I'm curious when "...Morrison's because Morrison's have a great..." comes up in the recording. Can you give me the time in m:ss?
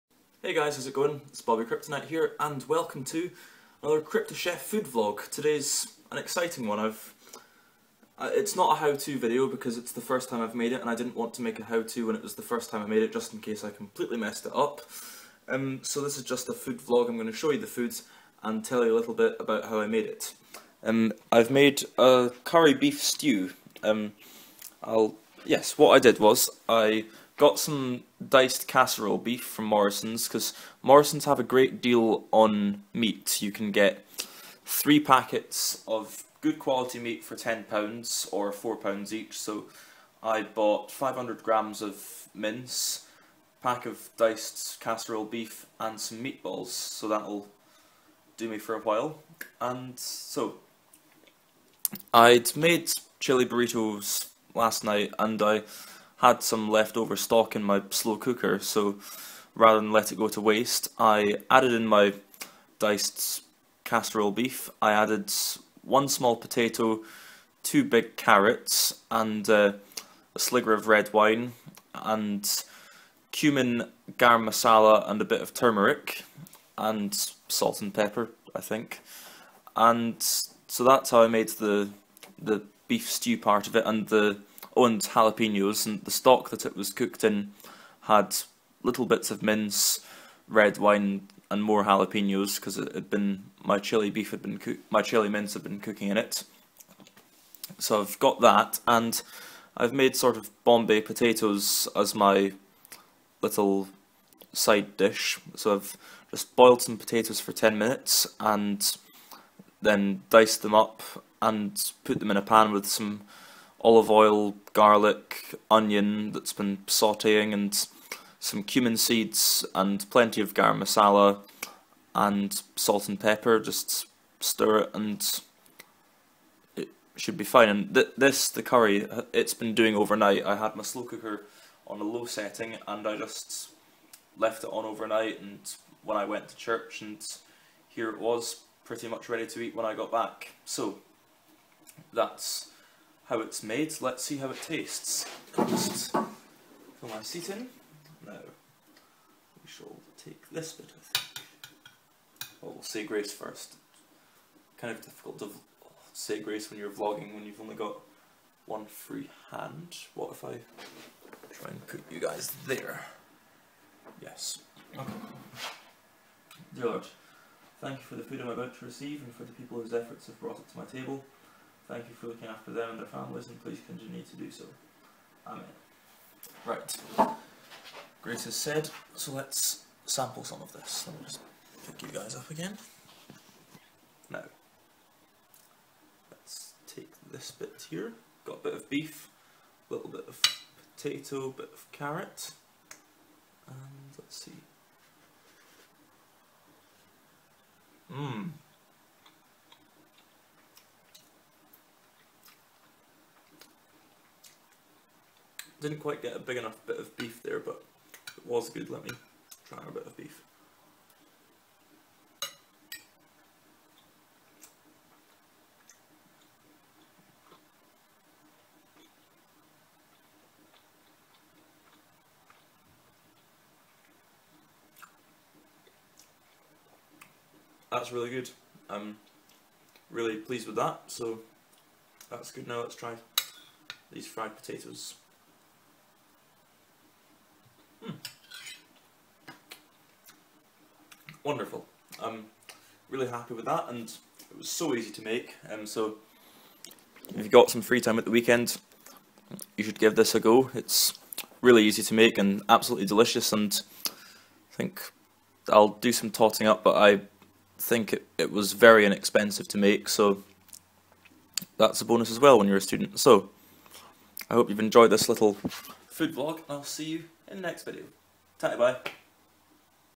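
0:29.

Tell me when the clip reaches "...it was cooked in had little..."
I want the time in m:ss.
1:26.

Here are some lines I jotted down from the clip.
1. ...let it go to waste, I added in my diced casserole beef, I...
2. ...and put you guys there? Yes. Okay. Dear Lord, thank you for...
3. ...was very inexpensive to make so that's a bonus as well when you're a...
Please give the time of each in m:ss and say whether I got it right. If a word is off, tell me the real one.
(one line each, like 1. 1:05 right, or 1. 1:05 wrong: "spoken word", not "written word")
1. 0:59 right
2. 2:41 right
3. 4:18 right.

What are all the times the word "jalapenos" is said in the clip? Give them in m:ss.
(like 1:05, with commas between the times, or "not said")
1:25, 1:31.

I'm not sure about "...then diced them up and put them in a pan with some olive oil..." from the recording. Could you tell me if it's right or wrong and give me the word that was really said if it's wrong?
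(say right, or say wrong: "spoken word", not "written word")
right.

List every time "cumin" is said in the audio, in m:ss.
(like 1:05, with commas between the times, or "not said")
1:13, 1:58.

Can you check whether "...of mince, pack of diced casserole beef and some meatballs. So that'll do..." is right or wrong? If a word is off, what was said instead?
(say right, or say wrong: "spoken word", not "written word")
right.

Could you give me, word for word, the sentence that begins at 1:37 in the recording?
So I've got that, and I've made sort of Bombay potatoes as my little side dish.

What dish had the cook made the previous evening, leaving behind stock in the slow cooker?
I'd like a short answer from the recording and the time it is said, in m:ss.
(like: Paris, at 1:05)
chili burritos, at 0:53.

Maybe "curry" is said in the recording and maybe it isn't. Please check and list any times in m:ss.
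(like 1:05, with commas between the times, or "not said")
0:22, 2:08.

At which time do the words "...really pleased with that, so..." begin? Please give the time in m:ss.
3:50.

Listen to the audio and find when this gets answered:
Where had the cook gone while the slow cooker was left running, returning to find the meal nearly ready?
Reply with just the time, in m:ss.
2:16.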